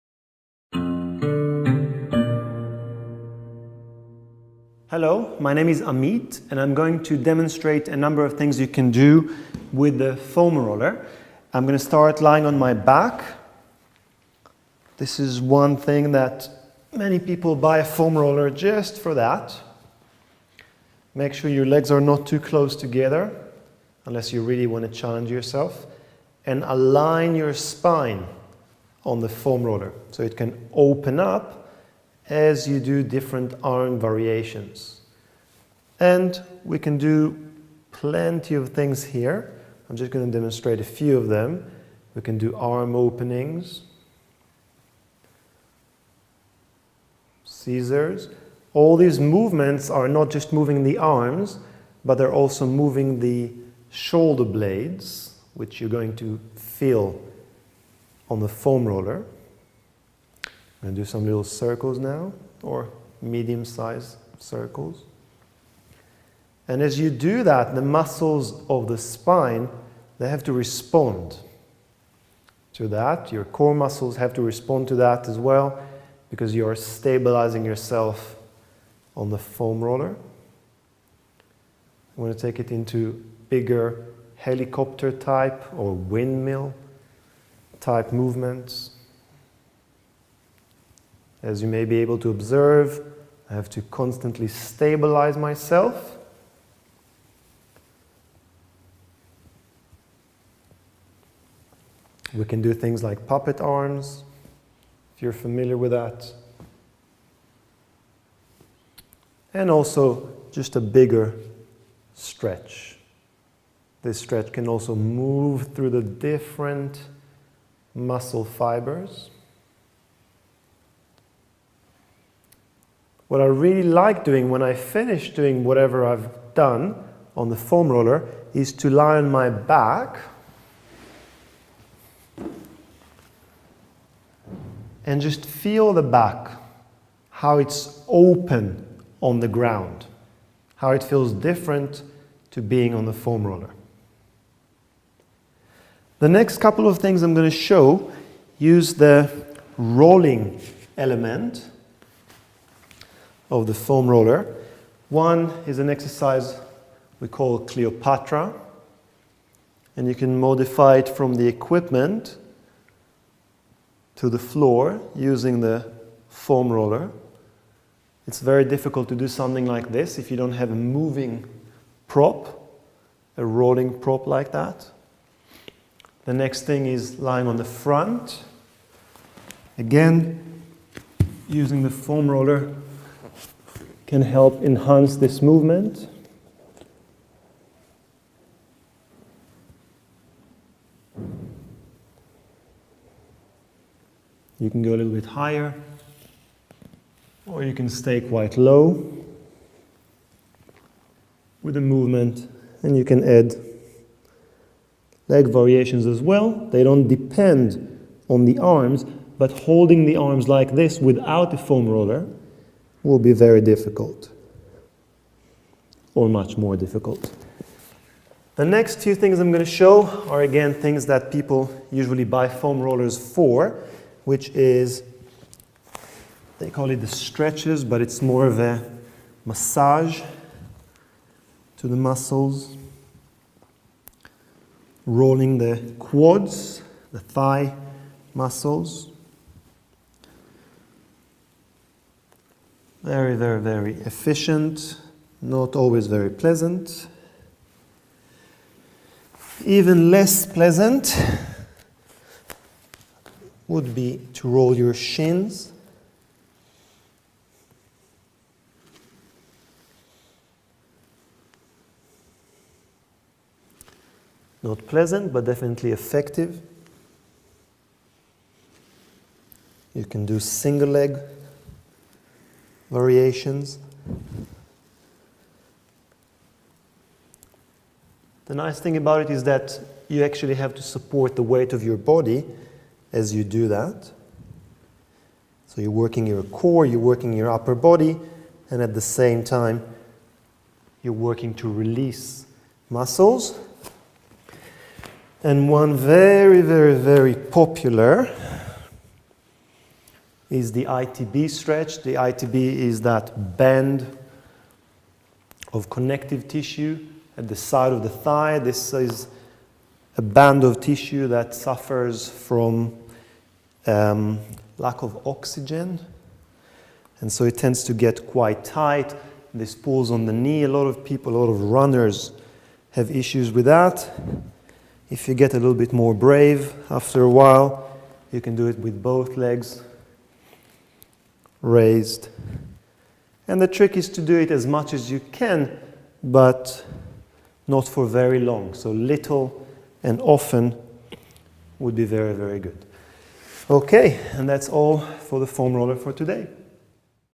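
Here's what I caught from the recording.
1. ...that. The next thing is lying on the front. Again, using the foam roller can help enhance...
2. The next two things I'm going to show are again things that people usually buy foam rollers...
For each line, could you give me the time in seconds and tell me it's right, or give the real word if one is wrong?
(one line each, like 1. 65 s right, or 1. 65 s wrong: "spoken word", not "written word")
1. 174 s right
2. 218 s right.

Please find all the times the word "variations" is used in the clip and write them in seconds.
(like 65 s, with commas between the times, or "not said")
33 s, 205 s, 272 s.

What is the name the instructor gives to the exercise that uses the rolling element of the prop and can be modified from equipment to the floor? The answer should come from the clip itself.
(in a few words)
Cleopatra.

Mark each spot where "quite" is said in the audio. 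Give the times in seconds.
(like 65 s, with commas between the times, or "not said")
198 s, 318 s.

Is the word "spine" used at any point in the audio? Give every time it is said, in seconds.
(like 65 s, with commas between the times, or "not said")
27 s, 68 s.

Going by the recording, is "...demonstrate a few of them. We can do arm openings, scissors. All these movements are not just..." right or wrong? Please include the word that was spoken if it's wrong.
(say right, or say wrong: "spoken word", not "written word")
right.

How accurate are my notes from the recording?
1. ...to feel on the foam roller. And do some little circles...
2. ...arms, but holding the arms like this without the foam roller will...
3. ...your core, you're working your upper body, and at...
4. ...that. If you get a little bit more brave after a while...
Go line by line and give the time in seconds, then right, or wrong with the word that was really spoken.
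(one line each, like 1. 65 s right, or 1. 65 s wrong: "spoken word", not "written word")
1. 56 s right
2. 208 s right
3. 286 s right
4. 323 s right.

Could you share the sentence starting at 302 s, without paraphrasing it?
The ITB is that band of connective tissue at the side of the thigh.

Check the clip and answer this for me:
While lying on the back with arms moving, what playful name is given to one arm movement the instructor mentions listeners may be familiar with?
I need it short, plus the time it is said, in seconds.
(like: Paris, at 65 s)
Puppet arms, at 103 s.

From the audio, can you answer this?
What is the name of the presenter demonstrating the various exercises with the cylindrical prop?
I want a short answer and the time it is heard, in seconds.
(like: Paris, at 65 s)
Amit, at 5 s.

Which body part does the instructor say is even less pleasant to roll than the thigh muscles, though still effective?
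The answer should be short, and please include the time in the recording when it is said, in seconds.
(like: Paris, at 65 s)
Shins, at 254 s.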